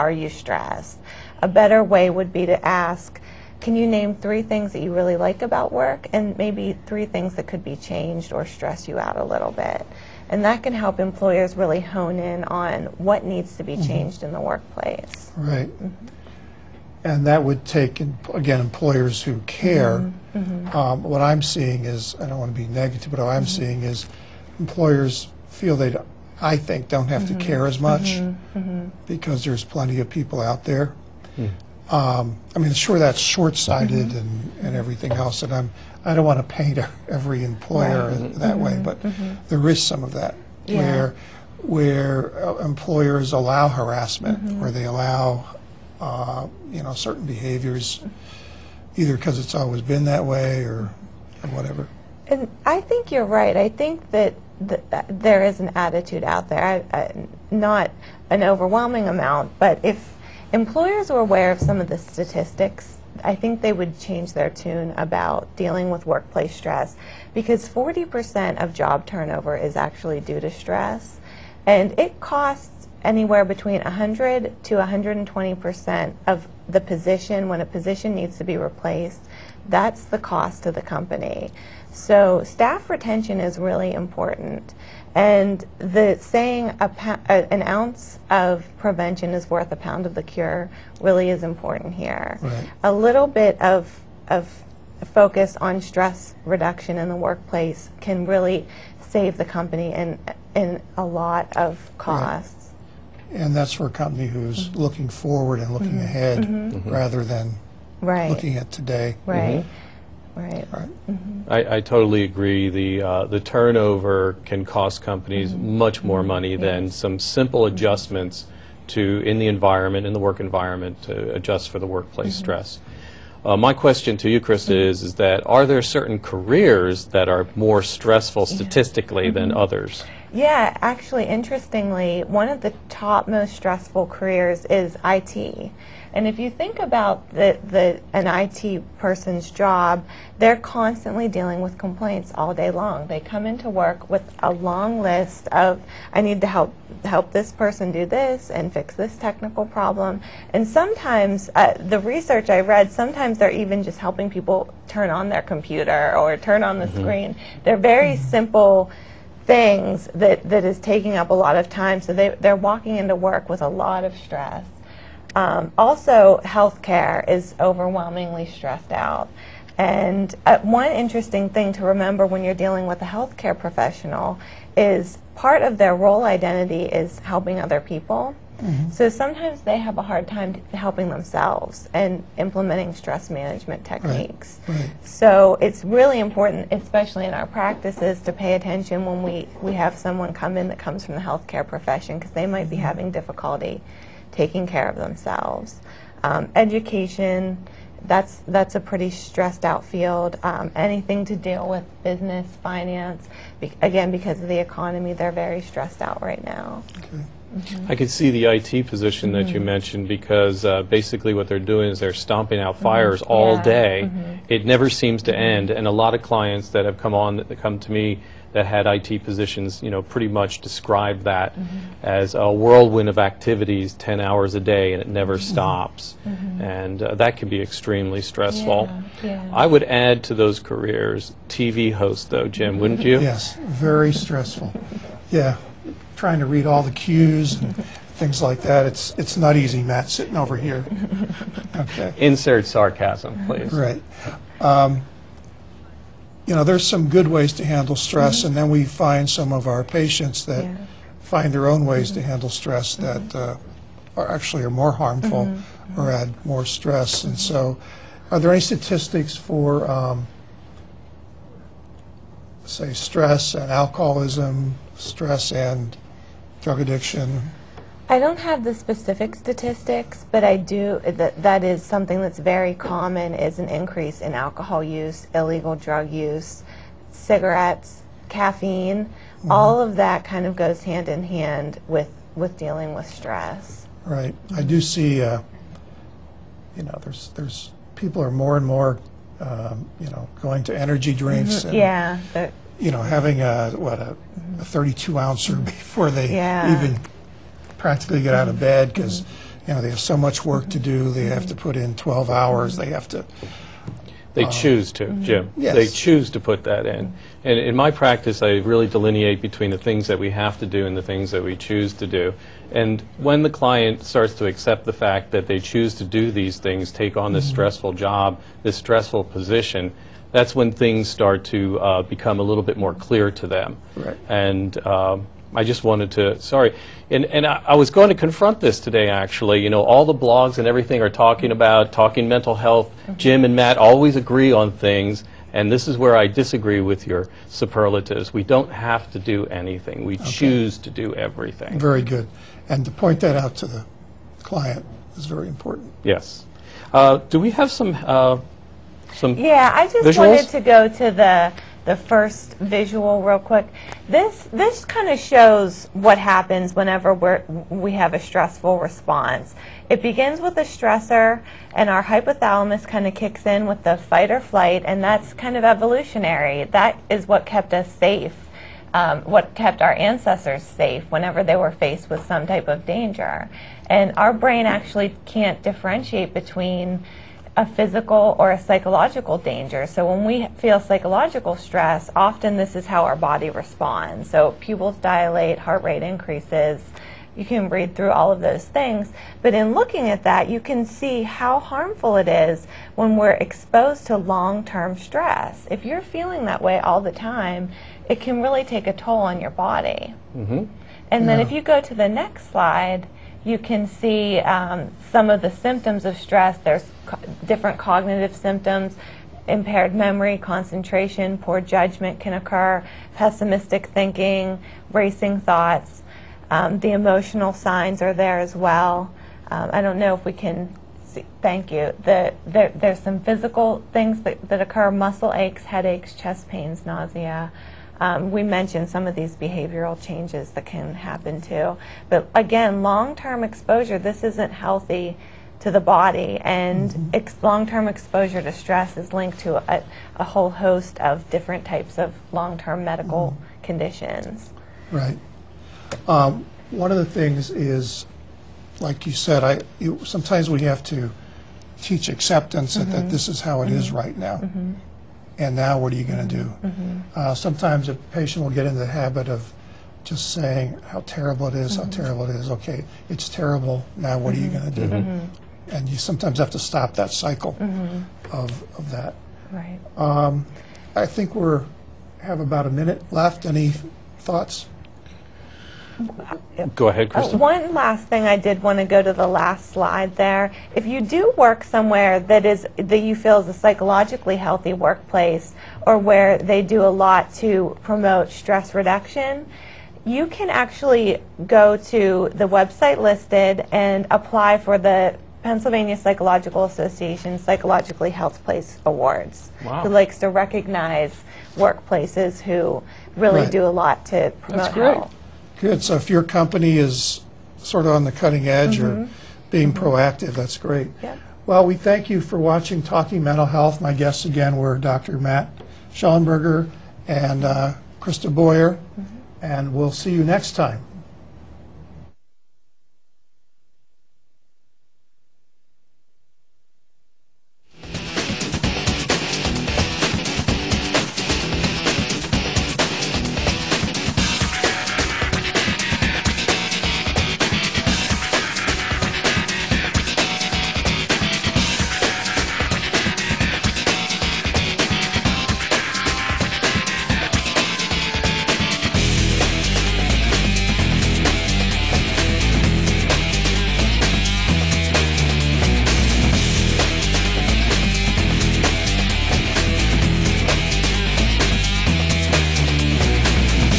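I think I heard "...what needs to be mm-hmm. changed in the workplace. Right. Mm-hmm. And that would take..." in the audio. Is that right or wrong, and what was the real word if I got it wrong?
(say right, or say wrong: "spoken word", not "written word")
right.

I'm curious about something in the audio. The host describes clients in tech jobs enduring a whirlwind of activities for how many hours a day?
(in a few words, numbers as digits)
10 hours.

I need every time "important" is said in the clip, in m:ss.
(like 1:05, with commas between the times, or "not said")
1:23, 1:31, 3:06, 5:45.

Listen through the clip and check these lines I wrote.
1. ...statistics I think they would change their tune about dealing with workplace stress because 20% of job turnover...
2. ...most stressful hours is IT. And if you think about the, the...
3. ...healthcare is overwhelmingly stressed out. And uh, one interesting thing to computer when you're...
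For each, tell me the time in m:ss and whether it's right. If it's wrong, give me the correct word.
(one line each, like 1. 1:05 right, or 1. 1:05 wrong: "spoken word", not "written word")
1. 1:01 wrong: "40", not "20"
2. 2:13 wrong: "careers", not "hours"
3. 2:46 wrong: "remember", not "computer".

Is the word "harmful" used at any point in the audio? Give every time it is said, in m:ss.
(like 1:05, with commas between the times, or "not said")
4:14, 6:31.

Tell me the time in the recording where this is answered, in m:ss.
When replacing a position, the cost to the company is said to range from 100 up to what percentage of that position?
1:14.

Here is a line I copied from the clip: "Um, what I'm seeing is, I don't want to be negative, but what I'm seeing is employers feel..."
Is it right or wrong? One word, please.
right.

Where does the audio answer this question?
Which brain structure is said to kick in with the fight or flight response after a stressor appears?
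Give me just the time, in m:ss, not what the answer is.
6:02.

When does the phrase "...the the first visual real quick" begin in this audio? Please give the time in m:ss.
5:51.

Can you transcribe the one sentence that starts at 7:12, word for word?
But again, long-term exposure, this isn't healthy to the body, and mm -hmm.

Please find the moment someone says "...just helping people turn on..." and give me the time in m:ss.
2:33.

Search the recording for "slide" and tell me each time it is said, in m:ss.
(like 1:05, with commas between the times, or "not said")
6:42, 7:59.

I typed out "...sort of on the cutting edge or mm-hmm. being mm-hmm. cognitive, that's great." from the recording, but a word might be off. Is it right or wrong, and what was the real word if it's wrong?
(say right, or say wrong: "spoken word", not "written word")
wrong: "proactive", not "cognitive".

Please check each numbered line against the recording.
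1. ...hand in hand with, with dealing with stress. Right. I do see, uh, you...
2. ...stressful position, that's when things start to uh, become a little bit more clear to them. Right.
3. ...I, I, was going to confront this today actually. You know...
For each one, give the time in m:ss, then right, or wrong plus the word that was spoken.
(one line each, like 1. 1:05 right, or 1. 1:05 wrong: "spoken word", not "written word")
1. 4:40 right
2. 5:18 right
3. 5:27 right.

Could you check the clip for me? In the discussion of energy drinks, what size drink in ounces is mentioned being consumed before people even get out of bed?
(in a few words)
32.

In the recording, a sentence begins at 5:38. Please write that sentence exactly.
We don't have to do anything, we okay.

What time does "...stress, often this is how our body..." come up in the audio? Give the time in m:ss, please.
6:21.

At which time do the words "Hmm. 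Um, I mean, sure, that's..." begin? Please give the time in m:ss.
0:31.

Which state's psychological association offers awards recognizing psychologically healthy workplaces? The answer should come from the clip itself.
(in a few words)
Pennsylvania.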